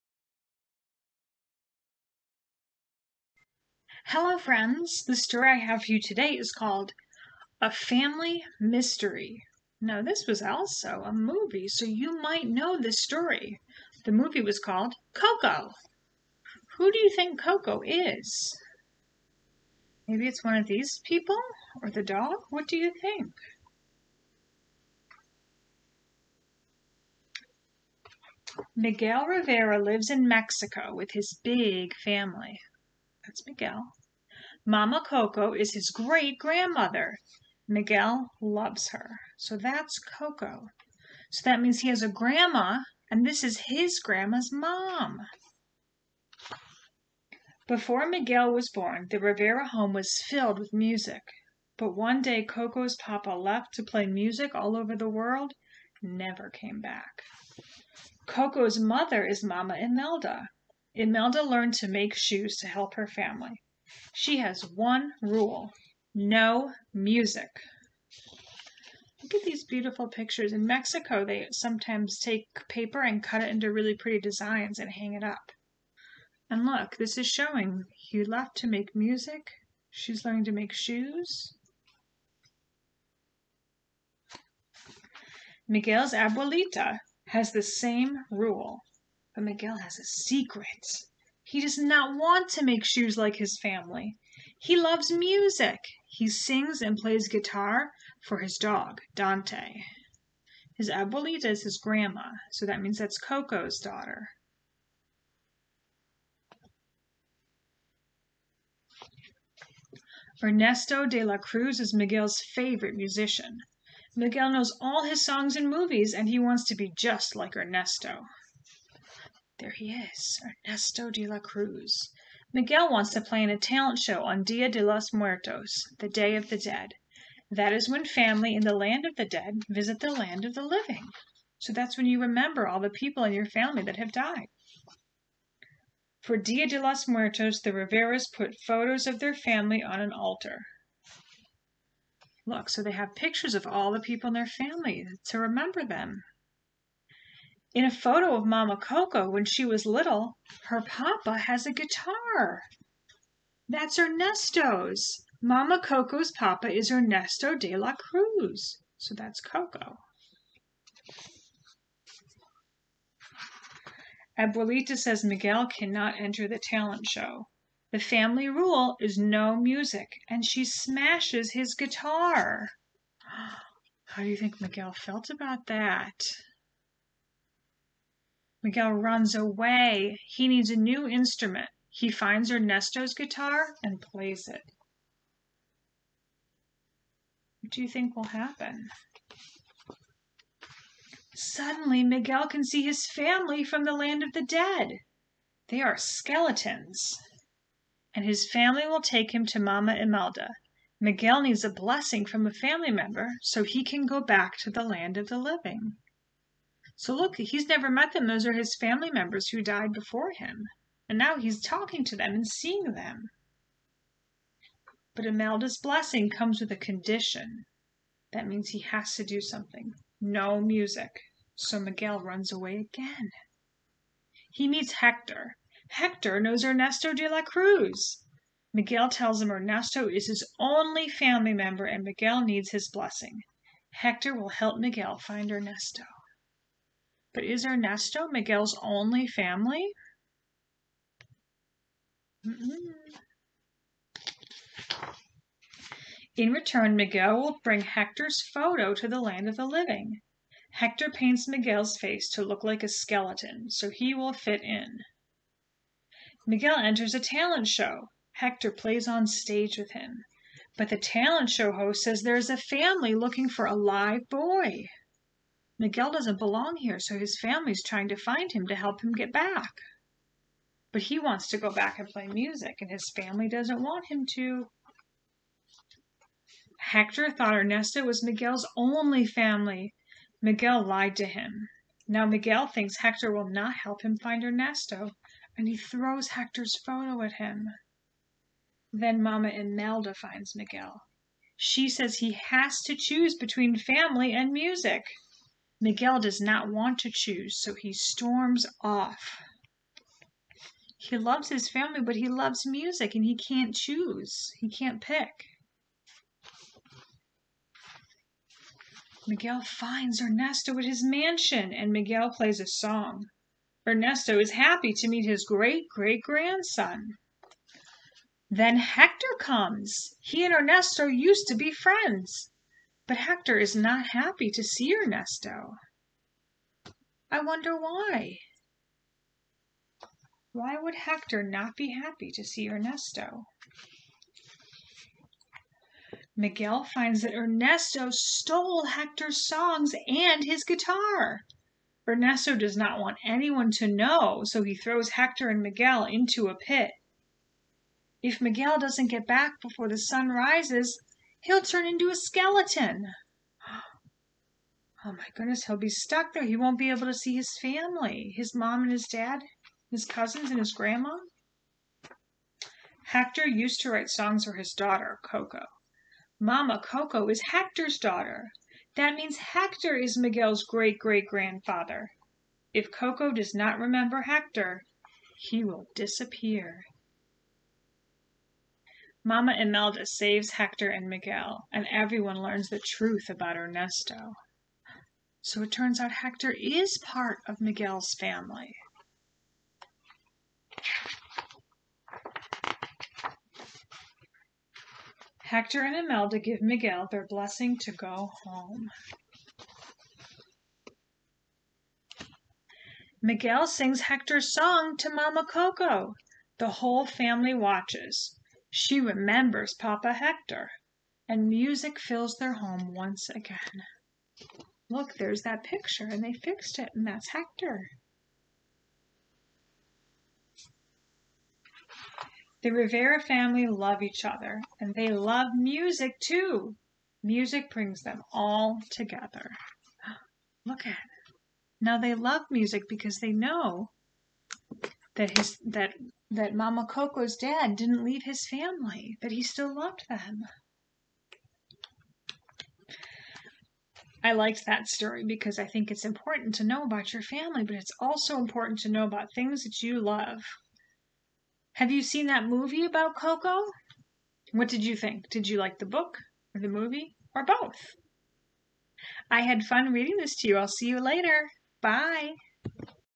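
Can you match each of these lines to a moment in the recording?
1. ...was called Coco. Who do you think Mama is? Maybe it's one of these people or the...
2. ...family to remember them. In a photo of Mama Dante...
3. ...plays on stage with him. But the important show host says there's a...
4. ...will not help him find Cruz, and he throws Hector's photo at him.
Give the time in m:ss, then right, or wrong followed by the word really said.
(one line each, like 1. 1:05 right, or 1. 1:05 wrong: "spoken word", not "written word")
1. 0:14 wrong: "Coco", not "Mama"
2. 2:24 wrong: "Coco", not "Dante"
3. 4:18 wrong: "talent", not "important"
4. 4:43 wrong: "Ernesto", not "Cruz".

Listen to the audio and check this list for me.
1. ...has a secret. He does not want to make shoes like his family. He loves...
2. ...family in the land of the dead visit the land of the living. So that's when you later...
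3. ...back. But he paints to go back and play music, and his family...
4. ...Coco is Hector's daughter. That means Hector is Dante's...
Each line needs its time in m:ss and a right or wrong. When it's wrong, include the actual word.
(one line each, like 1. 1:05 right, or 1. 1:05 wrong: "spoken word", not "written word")
1. 1:29 right
2. 2:08 wrong: "remember", not "later"
3. 4:29 wrong: "wants", not "paints"
4. 6:06 wrong: "Miguel", not "Dante".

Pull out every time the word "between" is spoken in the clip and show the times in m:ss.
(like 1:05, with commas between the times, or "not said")
4:53.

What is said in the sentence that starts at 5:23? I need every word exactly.
But Hector is not happy to see Ernesto.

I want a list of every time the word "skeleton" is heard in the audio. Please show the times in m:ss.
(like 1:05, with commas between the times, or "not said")
3:15, 4:12, 5:52.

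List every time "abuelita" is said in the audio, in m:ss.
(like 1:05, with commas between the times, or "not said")
1:26, 1:40, 2:44.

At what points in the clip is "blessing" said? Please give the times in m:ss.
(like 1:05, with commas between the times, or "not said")
3:21, 3:35, 3:52, 6:37.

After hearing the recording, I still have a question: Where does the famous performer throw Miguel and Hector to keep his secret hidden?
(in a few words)
Into a pit.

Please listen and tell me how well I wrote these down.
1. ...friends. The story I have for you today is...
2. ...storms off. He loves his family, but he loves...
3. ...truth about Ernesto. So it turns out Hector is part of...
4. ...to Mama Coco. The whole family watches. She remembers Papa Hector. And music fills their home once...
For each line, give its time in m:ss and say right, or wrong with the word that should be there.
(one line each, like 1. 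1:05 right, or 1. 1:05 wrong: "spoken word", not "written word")
1. 0:04 right
2. 4:57 right
3. 6:22 right
4. 6:44 right.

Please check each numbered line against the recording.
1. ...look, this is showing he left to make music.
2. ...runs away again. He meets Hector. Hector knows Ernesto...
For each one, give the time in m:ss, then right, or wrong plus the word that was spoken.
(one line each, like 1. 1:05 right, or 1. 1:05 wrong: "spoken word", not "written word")
1. 1:16 right
2. 3:42 right.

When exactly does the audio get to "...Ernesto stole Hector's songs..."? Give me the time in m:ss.
5:37.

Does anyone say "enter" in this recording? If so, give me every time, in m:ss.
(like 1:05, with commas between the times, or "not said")
2:46, 4:16.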